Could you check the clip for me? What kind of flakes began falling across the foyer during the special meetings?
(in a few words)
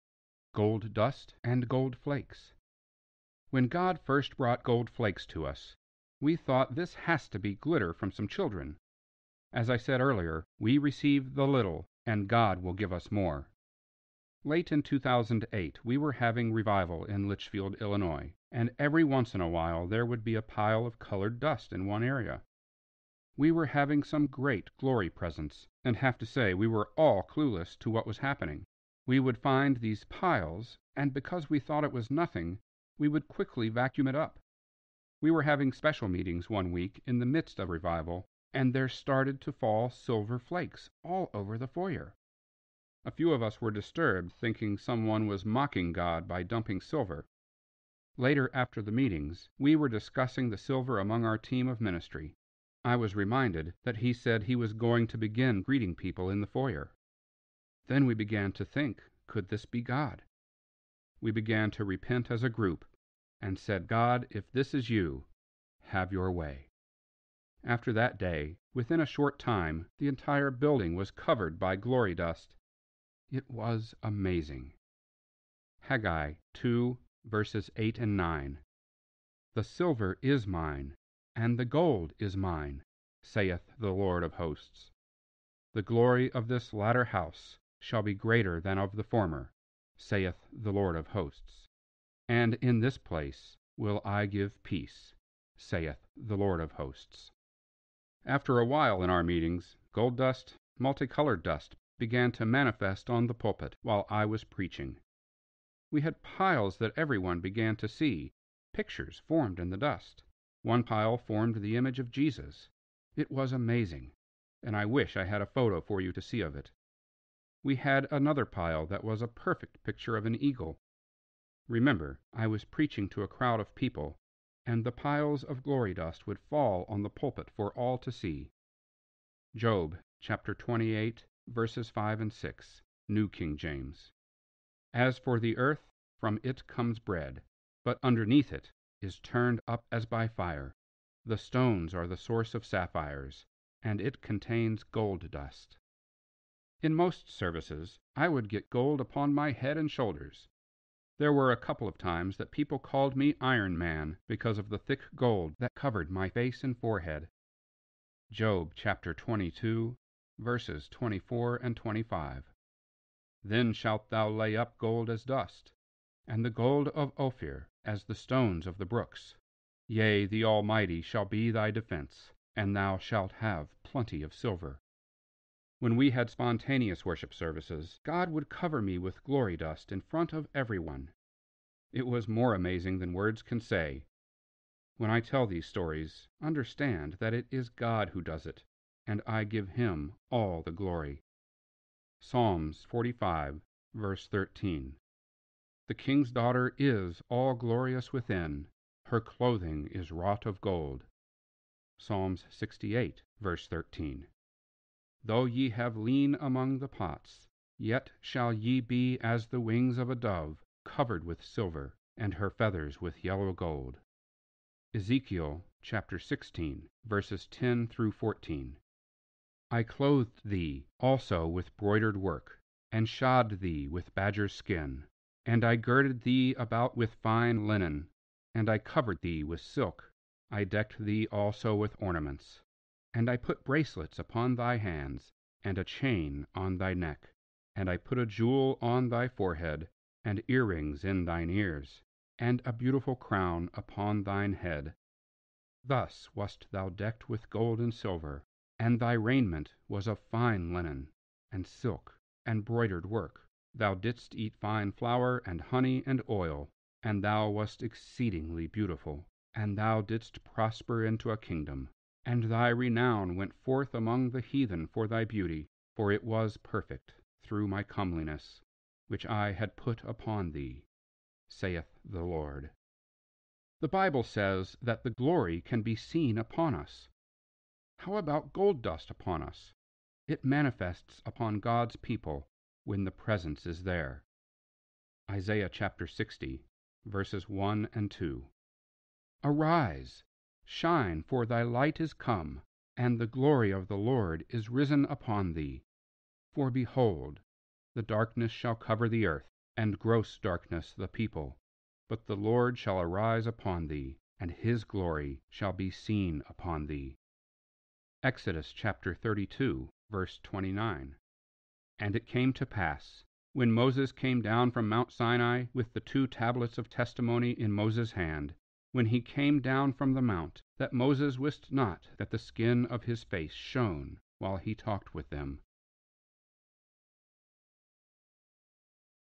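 Silver flakes.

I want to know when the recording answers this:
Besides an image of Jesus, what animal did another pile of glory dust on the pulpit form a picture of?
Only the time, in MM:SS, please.
02:00.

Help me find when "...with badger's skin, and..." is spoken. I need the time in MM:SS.
03:43.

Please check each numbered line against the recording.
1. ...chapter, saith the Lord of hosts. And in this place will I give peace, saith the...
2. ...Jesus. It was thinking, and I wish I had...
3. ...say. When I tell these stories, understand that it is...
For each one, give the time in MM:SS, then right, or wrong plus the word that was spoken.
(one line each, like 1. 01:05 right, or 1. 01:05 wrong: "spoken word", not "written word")
1. 01:29 wrong: "former", not "chapter"
2. 01:52 wrong: "amazing", not "thinking"
3. 03:03 right.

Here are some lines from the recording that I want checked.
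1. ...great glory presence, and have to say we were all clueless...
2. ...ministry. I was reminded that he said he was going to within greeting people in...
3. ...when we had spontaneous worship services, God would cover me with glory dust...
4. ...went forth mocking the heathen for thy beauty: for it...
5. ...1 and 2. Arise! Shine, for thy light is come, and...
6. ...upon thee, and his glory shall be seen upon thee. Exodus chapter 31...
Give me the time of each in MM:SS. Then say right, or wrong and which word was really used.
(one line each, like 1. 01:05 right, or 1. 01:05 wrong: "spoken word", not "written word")
1. 00:24 right
2. 00:51 wrong: "begin", not "within"
3. 02:55 right
4. 04:23 wrong: "among", not "mocking"
5. 04:47 right
6. 05:03 wrong: "32", not "31".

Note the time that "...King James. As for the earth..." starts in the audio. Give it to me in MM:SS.
02:13.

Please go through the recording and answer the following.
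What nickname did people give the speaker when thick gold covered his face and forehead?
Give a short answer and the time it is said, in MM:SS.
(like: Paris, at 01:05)
Iron Man, at 02:33.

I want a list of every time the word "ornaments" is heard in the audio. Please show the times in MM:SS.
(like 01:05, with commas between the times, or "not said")
03:52.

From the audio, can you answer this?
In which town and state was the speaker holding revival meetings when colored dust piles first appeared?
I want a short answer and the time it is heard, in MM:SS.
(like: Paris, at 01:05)
Litchfield, Illinois, at 00:17.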